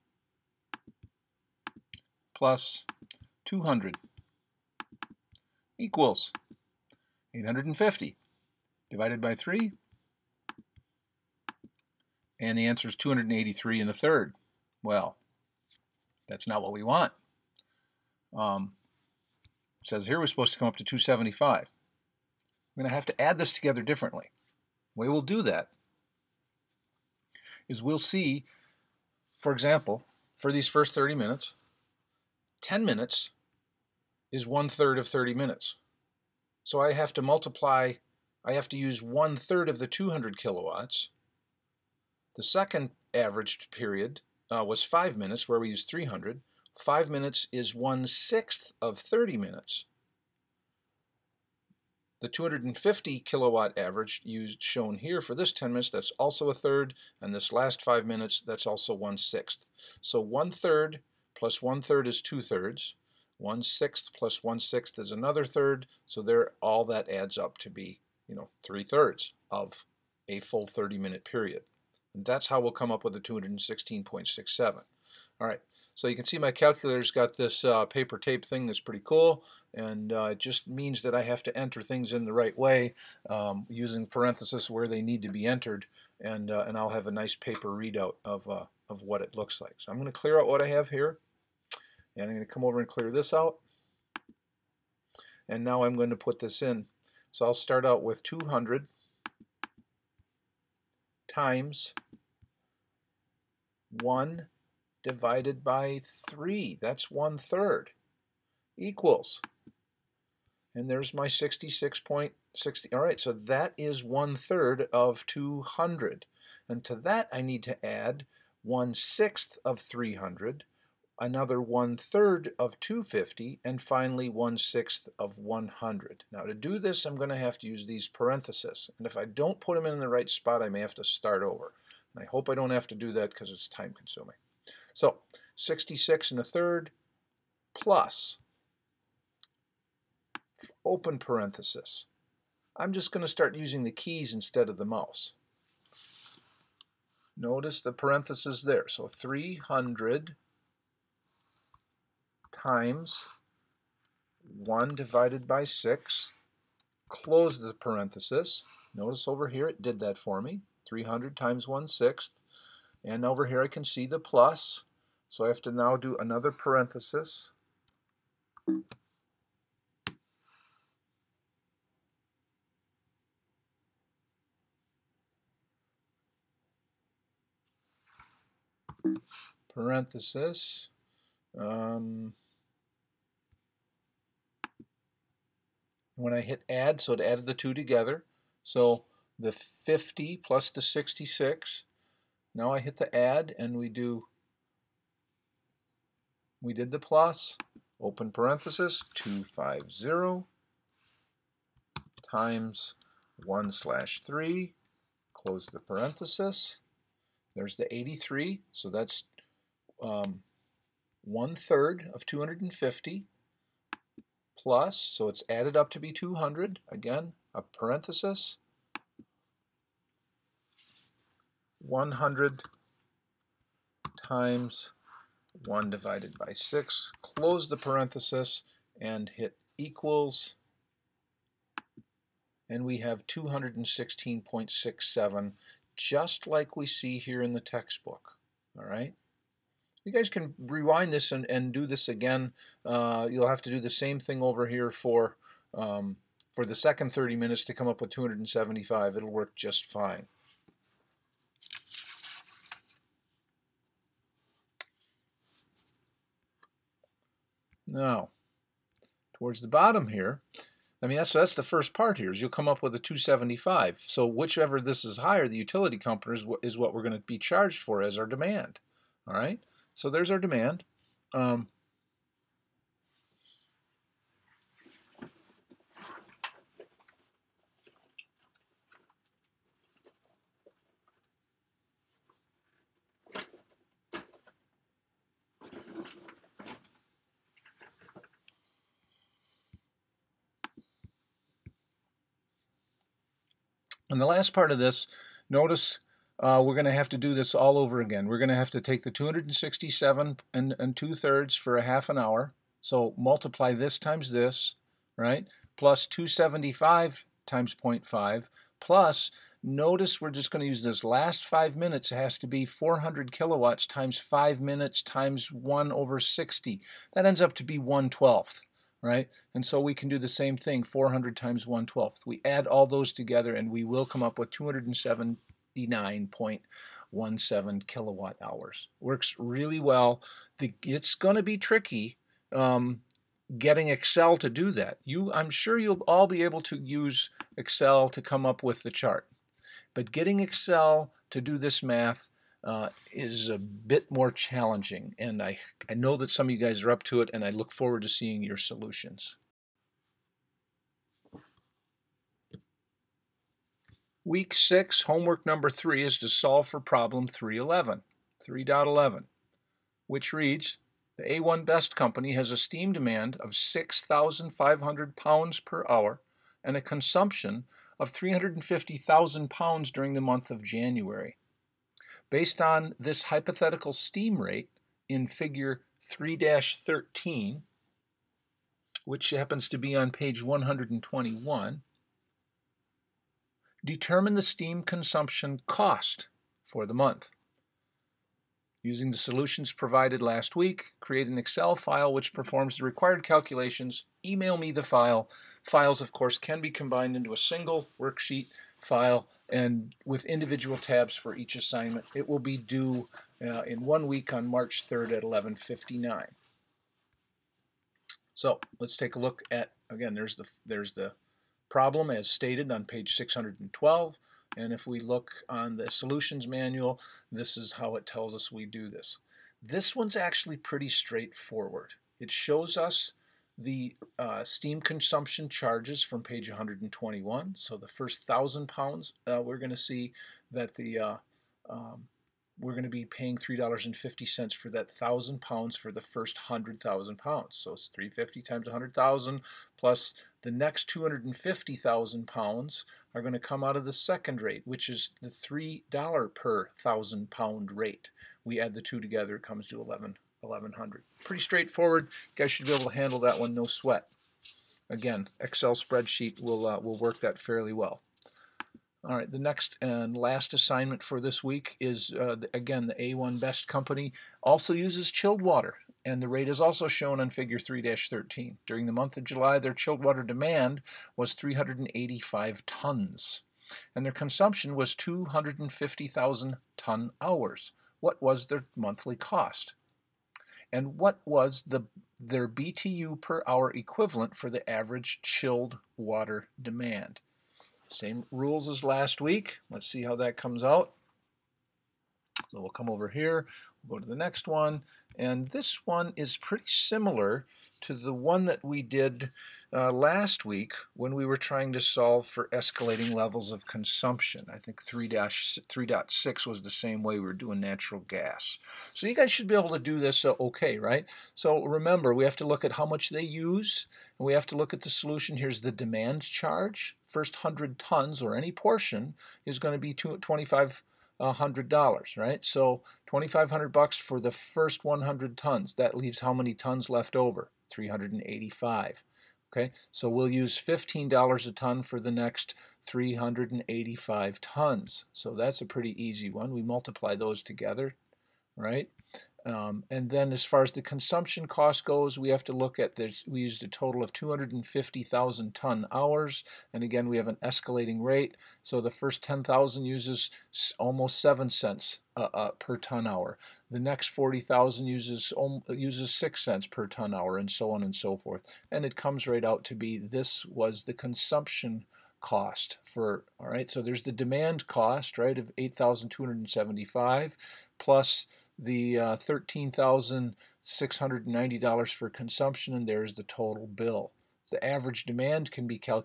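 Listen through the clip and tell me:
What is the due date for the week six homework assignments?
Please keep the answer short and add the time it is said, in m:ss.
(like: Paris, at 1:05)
March 3rd, at 6:44.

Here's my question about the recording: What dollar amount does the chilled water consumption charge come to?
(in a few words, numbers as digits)
$13,690.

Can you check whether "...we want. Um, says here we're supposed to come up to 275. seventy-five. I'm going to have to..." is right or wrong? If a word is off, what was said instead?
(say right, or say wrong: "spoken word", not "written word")
right.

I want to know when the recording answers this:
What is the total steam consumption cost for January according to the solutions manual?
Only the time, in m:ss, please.
7:31.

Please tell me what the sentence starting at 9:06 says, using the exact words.
And again, we have an escalating rate.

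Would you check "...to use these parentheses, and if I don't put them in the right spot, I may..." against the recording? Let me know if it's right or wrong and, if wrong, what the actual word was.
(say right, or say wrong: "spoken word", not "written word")
right.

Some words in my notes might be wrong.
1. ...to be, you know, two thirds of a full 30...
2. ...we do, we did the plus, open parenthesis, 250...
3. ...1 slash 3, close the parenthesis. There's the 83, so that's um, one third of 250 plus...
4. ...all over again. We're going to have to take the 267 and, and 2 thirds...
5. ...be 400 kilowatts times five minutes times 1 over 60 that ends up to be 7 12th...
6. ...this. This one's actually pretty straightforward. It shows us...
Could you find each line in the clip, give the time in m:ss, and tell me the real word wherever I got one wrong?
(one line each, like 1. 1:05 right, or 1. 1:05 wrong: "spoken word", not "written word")
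1. 1:07 wrong: "three", not "two"
2. 3:13 right
3. 3:23 right
4. 4:57 right
5. 5:12 wrong: "1", not "7"
6. 6:58 right.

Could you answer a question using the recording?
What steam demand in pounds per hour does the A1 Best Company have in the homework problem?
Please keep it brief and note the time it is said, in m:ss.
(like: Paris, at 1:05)
6,500, at 6:03.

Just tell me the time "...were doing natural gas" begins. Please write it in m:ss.
8:27.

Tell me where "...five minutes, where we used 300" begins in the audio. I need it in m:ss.
0:44.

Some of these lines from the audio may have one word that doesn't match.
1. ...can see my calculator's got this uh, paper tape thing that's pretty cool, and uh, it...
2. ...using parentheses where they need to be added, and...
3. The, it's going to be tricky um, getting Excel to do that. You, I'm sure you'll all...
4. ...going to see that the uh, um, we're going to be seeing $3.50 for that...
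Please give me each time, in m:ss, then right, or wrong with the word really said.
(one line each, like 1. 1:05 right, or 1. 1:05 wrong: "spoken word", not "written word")
1. 1:16 right
2. 1:23 wrong: "entered", not "added"
3. 5:30 right
4. 7:09 wrong: "paying", not "seeing".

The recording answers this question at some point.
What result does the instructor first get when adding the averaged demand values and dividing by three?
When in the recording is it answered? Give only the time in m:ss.
0:12.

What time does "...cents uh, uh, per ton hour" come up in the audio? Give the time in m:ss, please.
9:11.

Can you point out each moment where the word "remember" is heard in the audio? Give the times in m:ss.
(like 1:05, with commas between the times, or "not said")
8:31.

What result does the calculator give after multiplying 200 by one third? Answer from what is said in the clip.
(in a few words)
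66.60.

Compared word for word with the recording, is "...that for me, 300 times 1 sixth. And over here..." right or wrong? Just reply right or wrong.
right.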